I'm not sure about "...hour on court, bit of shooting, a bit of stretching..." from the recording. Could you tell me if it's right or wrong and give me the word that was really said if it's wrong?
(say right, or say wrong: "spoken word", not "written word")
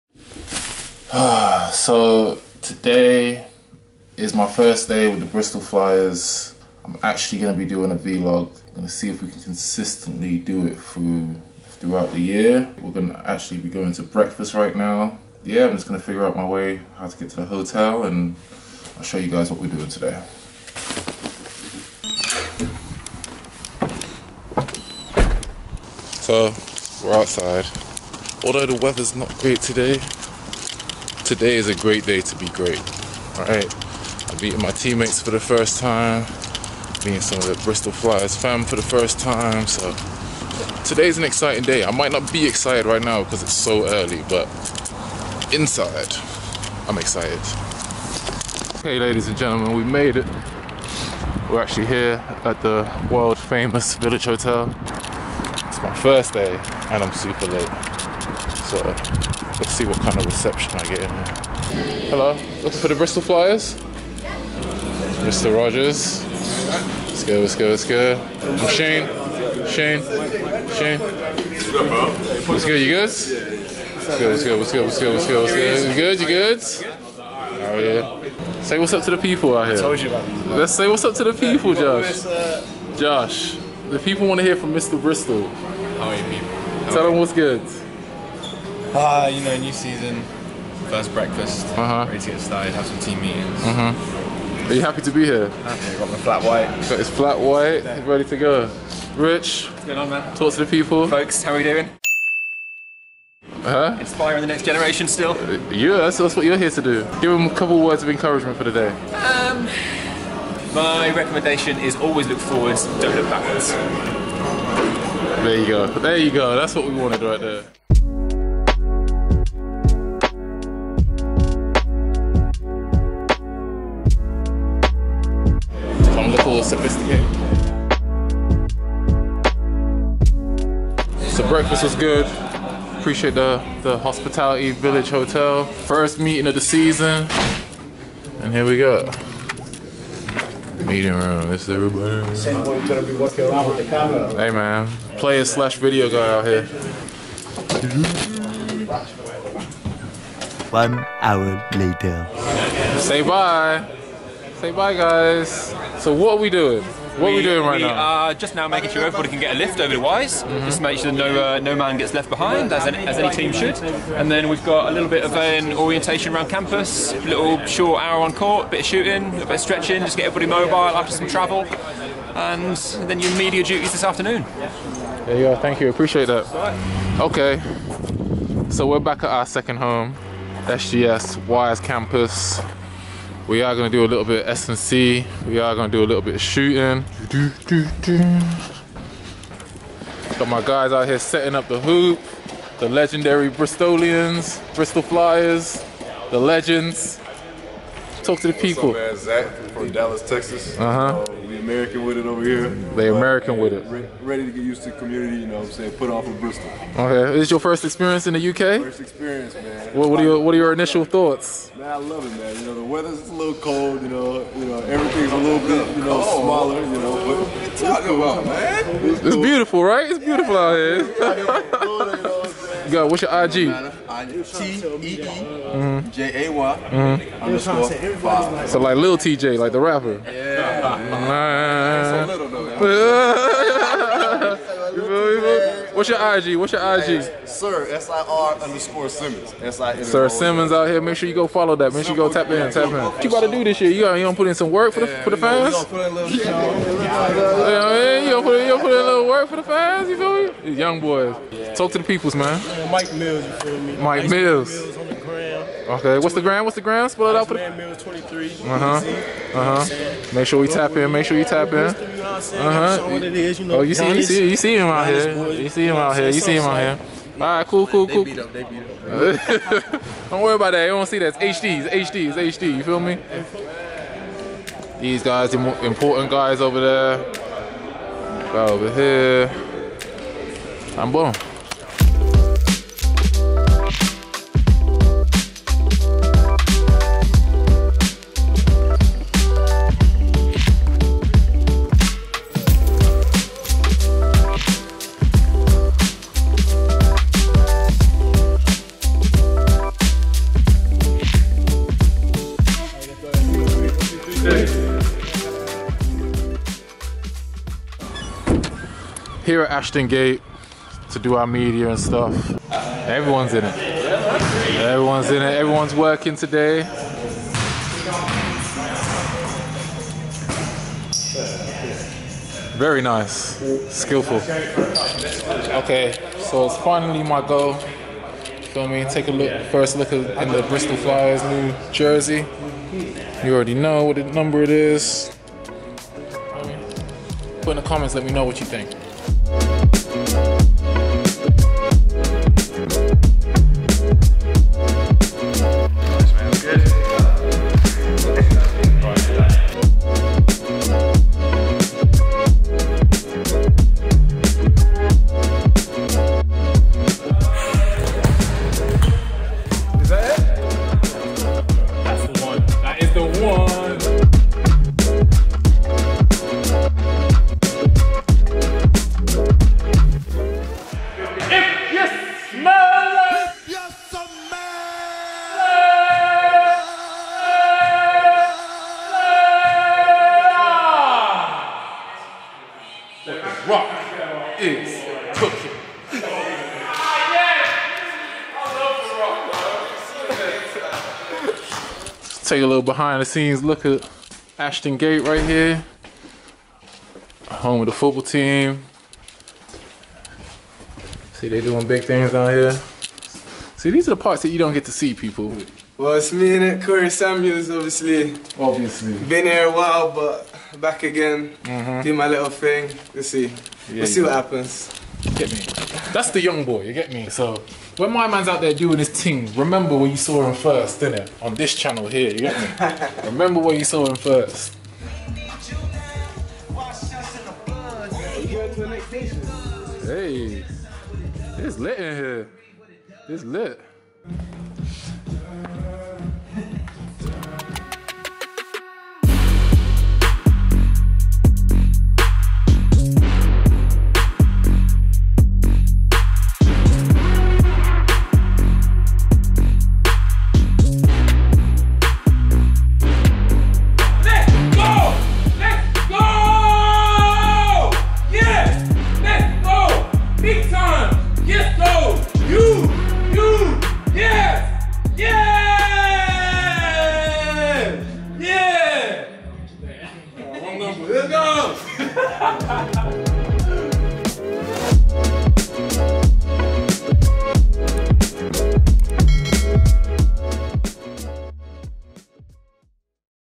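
right.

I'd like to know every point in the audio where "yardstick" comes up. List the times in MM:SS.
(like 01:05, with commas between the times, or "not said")
not said.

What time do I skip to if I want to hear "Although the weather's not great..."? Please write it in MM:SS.
00:28.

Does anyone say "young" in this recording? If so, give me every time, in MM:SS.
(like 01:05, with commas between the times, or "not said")
04:10, 06:56.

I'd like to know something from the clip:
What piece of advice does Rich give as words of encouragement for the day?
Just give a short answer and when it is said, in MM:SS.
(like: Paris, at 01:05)
Always look forwards, at 01:51.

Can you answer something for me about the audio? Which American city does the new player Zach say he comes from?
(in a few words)
Dallas, Texas.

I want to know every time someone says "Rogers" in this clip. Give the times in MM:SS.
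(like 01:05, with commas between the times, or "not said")
01:05.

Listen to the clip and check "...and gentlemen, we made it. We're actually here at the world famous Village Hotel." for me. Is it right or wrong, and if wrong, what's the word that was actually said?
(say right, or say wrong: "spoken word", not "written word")
right.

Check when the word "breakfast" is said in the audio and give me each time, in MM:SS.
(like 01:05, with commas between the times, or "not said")
00:14, 01:31, 02:11.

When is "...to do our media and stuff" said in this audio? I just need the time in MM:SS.
05:11.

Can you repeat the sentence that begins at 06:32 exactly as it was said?
Take a little behind the scenes look at Ashton Gate right here.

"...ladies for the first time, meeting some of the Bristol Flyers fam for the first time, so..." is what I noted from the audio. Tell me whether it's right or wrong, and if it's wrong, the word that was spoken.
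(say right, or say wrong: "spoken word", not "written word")
wrong: "teammates", not "ladies".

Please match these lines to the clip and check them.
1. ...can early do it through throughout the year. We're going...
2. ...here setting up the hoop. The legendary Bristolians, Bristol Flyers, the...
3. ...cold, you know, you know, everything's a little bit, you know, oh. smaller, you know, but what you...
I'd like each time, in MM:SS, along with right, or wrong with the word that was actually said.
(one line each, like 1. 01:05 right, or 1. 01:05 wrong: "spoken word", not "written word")
1. 00:09 wrong: "consistently", not "early"
2. 03:11 right
3. 03:33 right.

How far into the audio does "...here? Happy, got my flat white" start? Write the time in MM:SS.
01:35.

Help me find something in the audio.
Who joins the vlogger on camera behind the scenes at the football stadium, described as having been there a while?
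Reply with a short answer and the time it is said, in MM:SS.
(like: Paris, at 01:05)
Corey Samuels, at 06:46.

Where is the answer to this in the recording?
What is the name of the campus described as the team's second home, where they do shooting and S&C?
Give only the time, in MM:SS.
03:00.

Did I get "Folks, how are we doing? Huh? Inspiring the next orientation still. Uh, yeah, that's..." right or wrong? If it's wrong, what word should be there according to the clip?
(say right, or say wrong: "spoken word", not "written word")
wrong: "generation", not "orientation".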